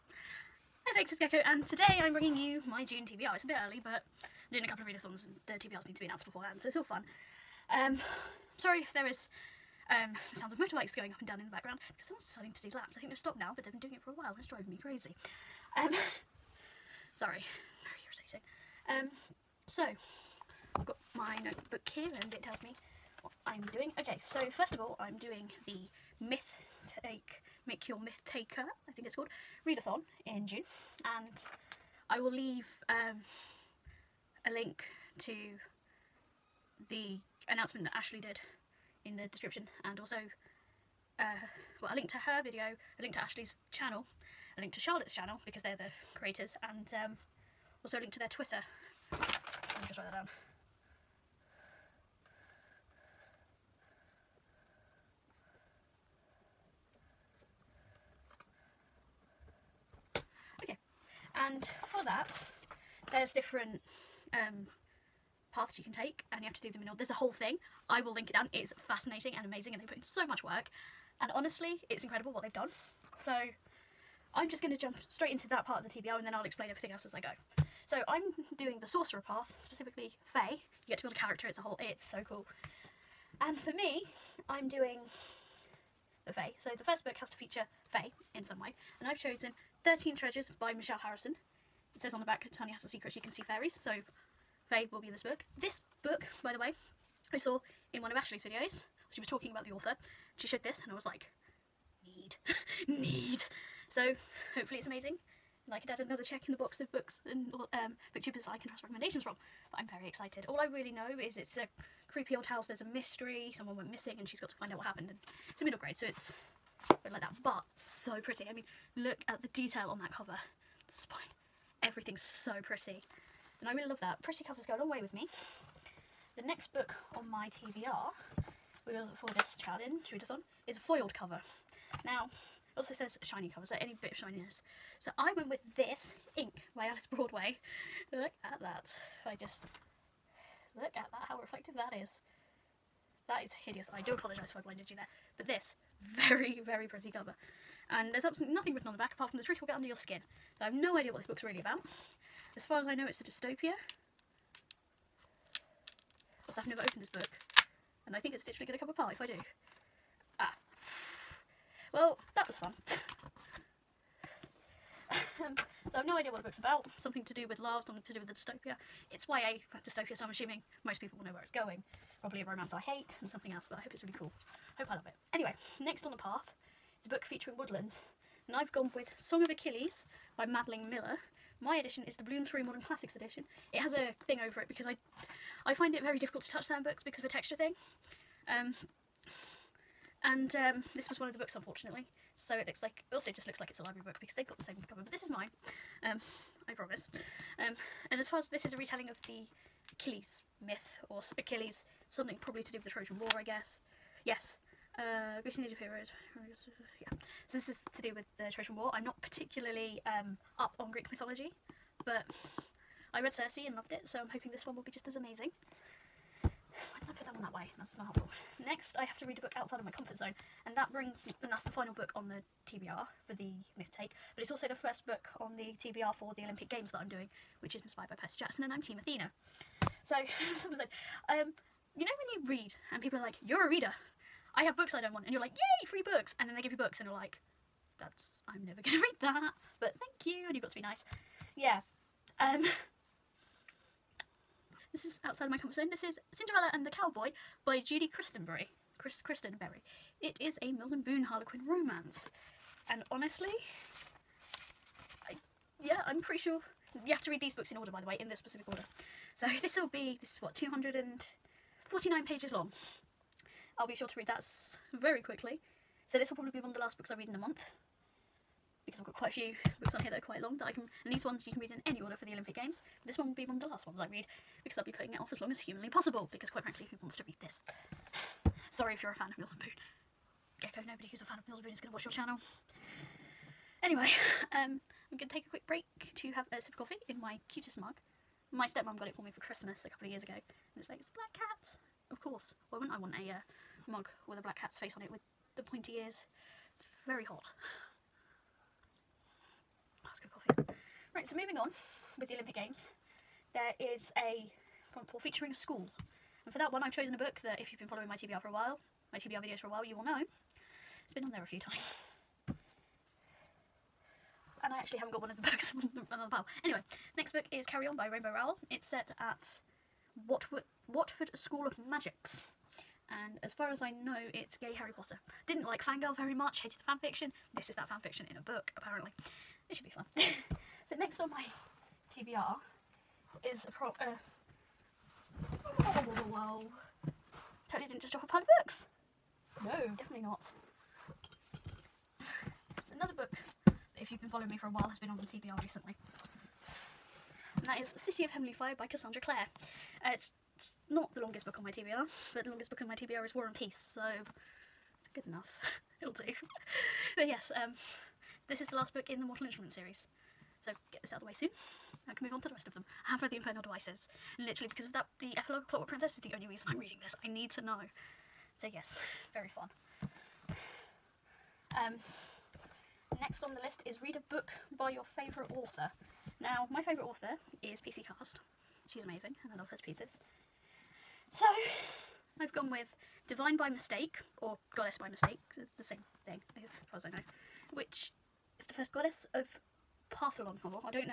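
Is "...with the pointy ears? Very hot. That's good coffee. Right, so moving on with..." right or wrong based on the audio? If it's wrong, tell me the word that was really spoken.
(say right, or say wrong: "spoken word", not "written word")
right.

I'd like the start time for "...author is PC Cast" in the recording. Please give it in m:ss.
6:17.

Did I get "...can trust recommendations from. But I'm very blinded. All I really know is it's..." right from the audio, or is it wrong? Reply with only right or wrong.
wrong.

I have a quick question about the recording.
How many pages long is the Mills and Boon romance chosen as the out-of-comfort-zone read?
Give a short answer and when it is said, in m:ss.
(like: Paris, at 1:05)
249, at 4:20.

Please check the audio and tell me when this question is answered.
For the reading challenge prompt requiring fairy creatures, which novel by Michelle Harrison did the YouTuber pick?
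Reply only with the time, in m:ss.
1:29.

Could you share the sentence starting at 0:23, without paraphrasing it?
Okay, so first of all, I'm doing the myth take, make your myth taker, I think it's called, readathon in June.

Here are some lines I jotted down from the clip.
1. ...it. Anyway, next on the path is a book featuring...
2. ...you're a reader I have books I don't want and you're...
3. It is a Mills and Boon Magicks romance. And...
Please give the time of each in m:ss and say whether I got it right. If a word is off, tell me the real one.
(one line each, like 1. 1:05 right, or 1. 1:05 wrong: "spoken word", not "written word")
1. 2:55 right
2. 3:53 right
3. 4:10 wrong: "Harlequin", not "Magicks".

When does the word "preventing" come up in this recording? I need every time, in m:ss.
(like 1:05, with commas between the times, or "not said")
not said.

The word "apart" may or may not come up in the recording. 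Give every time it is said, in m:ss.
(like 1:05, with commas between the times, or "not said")
2:29, 2:38.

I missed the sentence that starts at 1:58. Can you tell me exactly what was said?
I mean, look at the detail on that cover.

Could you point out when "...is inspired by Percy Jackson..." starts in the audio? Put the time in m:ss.
3:47.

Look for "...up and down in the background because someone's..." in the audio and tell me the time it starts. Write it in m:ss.
0:11.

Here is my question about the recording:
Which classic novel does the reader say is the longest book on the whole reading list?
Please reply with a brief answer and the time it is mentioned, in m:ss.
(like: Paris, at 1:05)
War and Peace, at 5:53.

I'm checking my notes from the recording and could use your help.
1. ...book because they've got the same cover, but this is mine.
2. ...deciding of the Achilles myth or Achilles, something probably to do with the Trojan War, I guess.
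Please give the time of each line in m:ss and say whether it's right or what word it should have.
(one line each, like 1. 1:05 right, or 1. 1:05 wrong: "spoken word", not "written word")
1. 3:14 right
2. 3:18 wrong: "retelling", not "deciding".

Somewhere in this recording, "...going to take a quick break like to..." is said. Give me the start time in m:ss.
4:45.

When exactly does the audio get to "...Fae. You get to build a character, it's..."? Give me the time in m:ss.
1:20.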